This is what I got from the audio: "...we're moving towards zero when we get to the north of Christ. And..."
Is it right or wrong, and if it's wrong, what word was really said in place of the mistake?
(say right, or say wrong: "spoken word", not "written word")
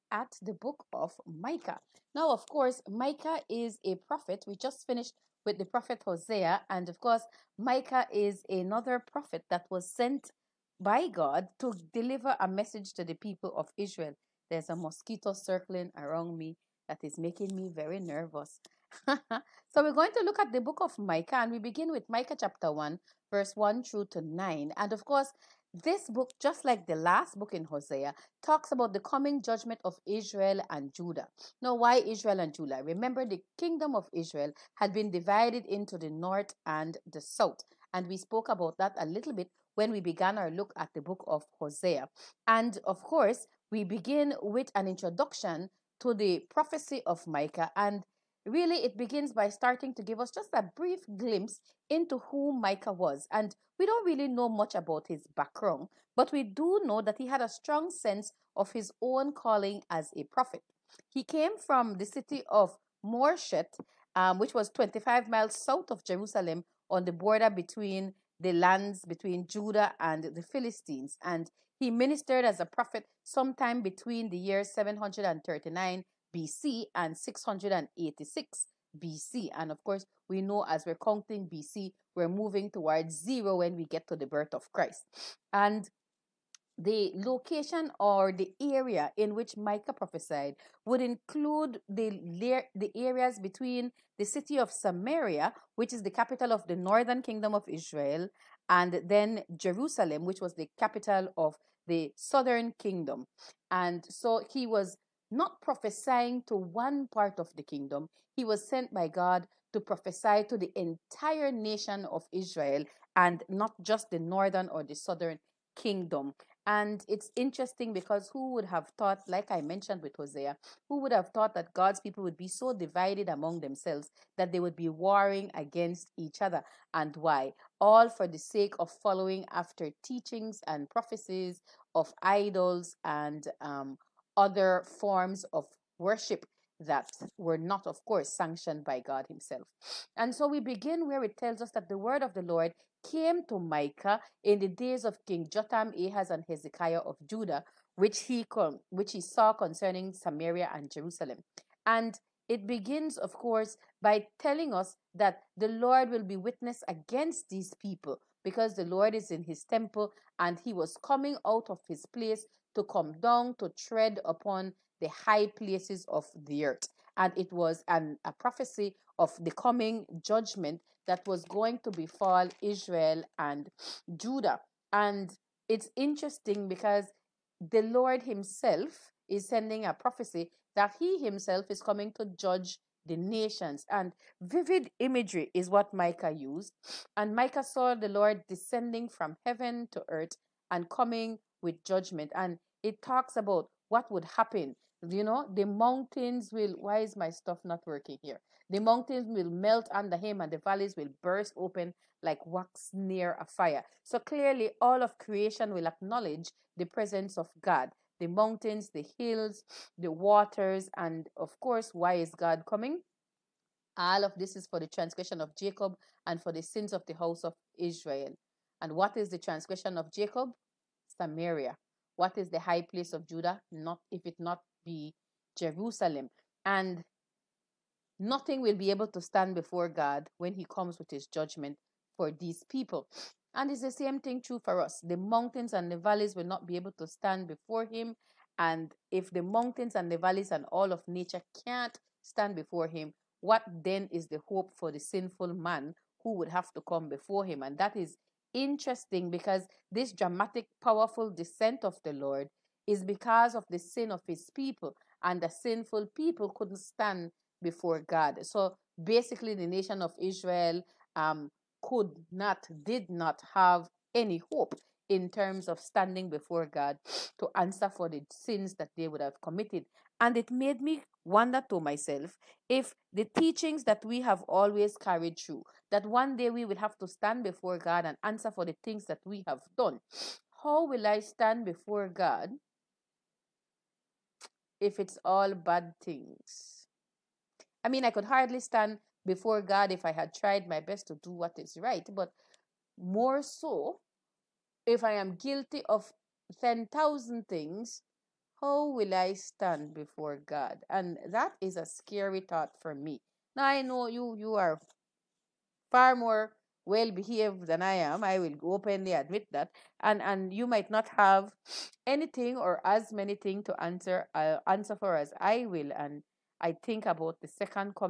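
wrong: "birth", not "north".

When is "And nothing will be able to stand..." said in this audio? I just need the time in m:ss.
3:46.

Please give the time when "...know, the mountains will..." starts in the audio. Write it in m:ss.
3:15.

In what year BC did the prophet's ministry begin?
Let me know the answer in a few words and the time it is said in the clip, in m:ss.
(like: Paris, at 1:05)
739 BC, at 1:14.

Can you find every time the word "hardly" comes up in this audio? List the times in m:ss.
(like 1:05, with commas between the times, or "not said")
4:48.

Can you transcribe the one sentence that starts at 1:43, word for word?
And so he was not prophesying to one part of the kingdom.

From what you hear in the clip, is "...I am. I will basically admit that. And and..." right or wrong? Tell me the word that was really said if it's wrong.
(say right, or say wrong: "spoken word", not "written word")
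wrong: "openly", not "basically".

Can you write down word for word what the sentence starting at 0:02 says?
Now, of course, Micah is a prophet.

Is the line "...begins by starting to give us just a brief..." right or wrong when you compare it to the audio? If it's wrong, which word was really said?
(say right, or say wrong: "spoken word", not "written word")
right.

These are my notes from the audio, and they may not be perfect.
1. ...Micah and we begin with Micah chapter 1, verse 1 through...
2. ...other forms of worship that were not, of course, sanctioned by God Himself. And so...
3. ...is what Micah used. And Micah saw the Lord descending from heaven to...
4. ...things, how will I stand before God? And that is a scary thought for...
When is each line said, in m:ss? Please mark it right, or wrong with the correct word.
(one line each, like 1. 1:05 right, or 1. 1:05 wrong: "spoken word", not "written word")
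1. 0:20 right
2. 2:14 right
3. 3:05 right
4. 4:57 right.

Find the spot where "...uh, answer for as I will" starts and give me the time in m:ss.
5:14.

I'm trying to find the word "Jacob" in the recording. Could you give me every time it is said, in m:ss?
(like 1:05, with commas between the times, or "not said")
3:35, 3:40.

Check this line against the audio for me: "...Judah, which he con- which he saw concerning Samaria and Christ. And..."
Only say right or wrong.
wrong.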